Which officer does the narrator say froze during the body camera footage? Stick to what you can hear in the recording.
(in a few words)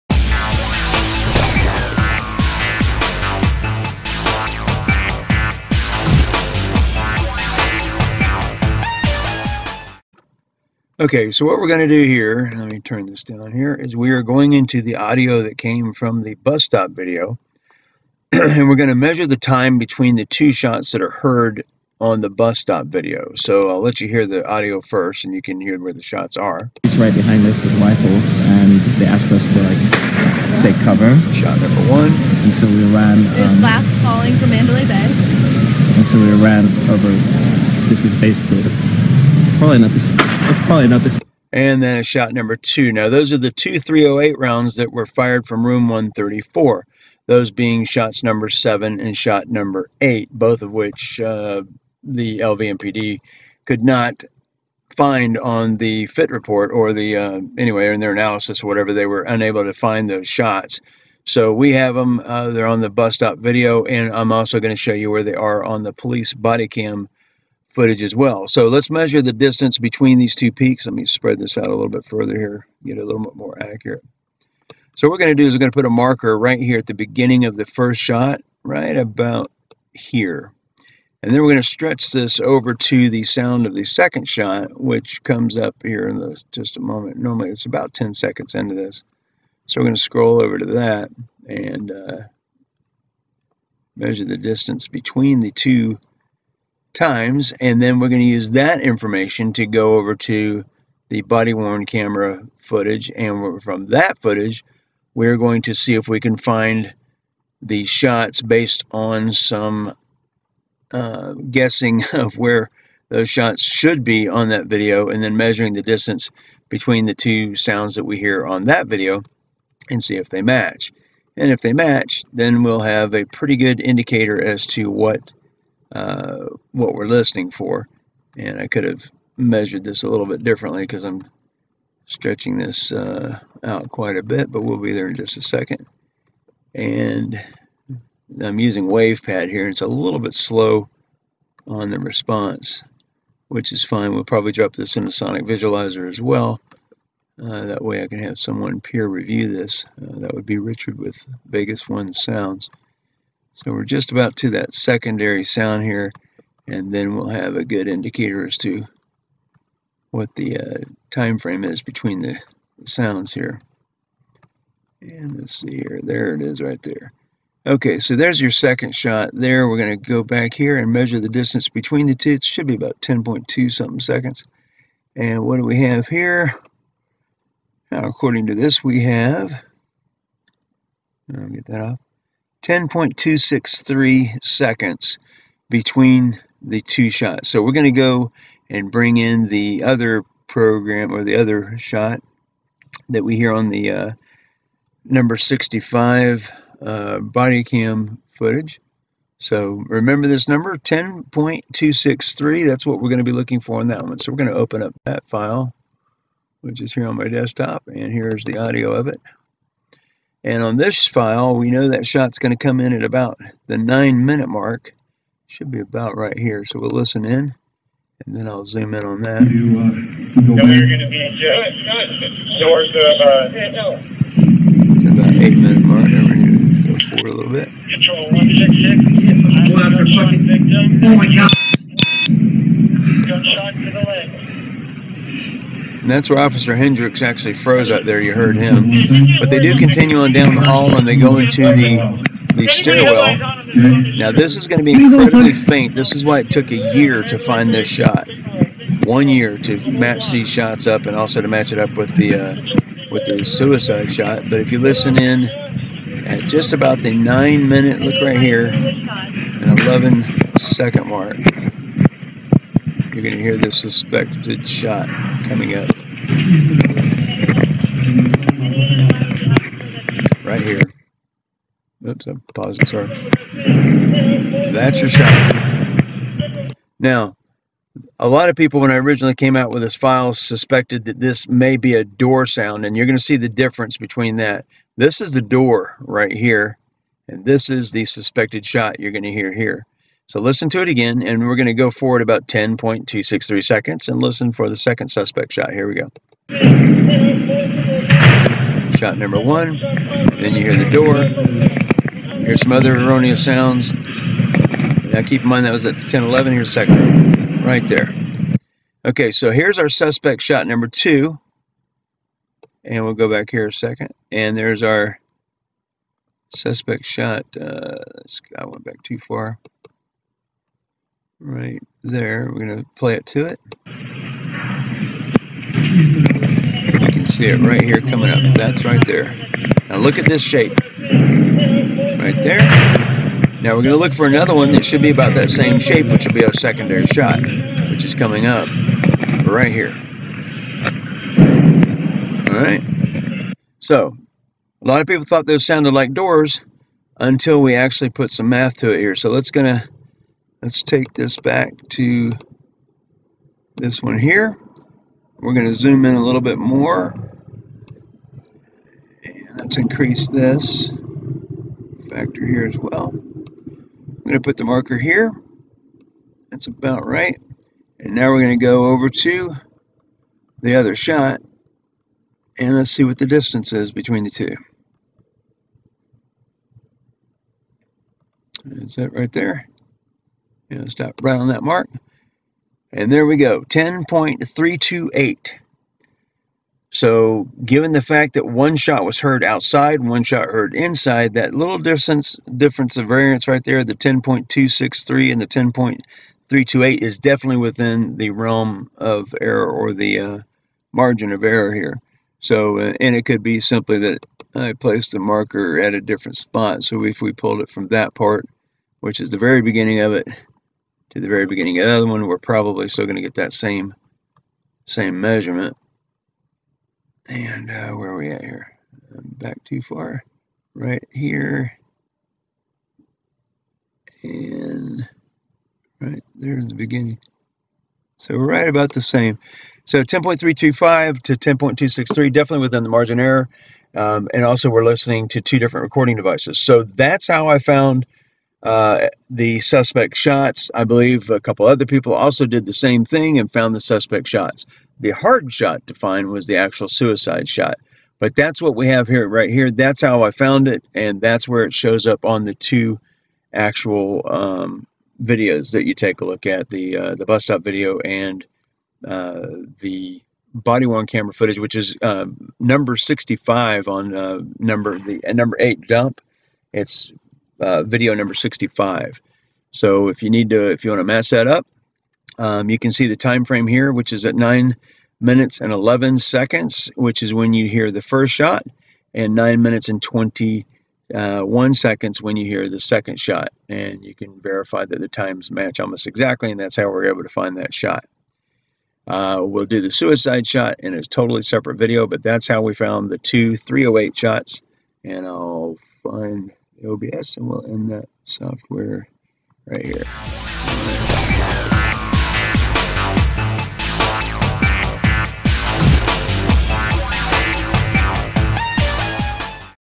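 Officer Hendrex.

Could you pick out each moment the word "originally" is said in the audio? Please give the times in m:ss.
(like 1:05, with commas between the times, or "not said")
4:38.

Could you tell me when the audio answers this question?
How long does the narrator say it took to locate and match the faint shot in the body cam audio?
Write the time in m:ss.
4:09.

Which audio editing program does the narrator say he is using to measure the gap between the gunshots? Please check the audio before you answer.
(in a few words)
WavePad.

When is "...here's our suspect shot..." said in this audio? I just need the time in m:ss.
5:09.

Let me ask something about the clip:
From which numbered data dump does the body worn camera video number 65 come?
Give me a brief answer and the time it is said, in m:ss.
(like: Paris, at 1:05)
Number 8, at 7:45.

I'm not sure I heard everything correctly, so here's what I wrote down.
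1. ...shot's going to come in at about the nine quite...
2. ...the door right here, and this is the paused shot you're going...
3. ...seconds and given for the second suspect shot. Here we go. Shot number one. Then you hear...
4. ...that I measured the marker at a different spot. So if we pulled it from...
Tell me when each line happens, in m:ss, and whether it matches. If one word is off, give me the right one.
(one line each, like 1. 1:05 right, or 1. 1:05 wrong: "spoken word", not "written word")
1. 3:32 wrong: "minute", not "quite"
2. 4:45 wrong: "suspected", not "paused"
3. 4:53 wrong: "listen", not "given"
4. 6:43 wrong: "placed", not "measured".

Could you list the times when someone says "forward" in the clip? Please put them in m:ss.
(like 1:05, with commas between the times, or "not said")
3:46, 4:51.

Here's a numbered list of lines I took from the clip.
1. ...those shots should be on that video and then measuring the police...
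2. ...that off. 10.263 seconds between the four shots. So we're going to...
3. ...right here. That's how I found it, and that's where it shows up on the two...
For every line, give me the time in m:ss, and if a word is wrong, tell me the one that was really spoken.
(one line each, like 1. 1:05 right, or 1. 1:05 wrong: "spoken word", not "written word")
1. 1:53 wrong: "distance", not "police"
2. 3:01 wrong: "two", not "four"
3. 7:29 right.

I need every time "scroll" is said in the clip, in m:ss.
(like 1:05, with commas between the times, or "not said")
1:30.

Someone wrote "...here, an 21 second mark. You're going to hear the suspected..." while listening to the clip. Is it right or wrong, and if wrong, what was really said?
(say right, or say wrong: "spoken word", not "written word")
wrong: "11", not "21".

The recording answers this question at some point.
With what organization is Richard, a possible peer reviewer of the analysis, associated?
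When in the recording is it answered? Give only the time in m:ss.
2:31.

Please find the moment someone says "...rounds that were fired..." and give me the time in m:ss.
0:44.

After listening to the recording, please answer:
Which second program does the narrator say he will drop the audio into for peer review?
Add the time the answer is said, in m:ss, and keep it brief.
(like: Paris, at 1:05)
Sonic Visualiser, at 2:25.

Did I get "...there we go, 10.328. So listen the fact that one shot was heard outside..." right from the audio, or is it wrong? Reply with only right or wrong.
wrong.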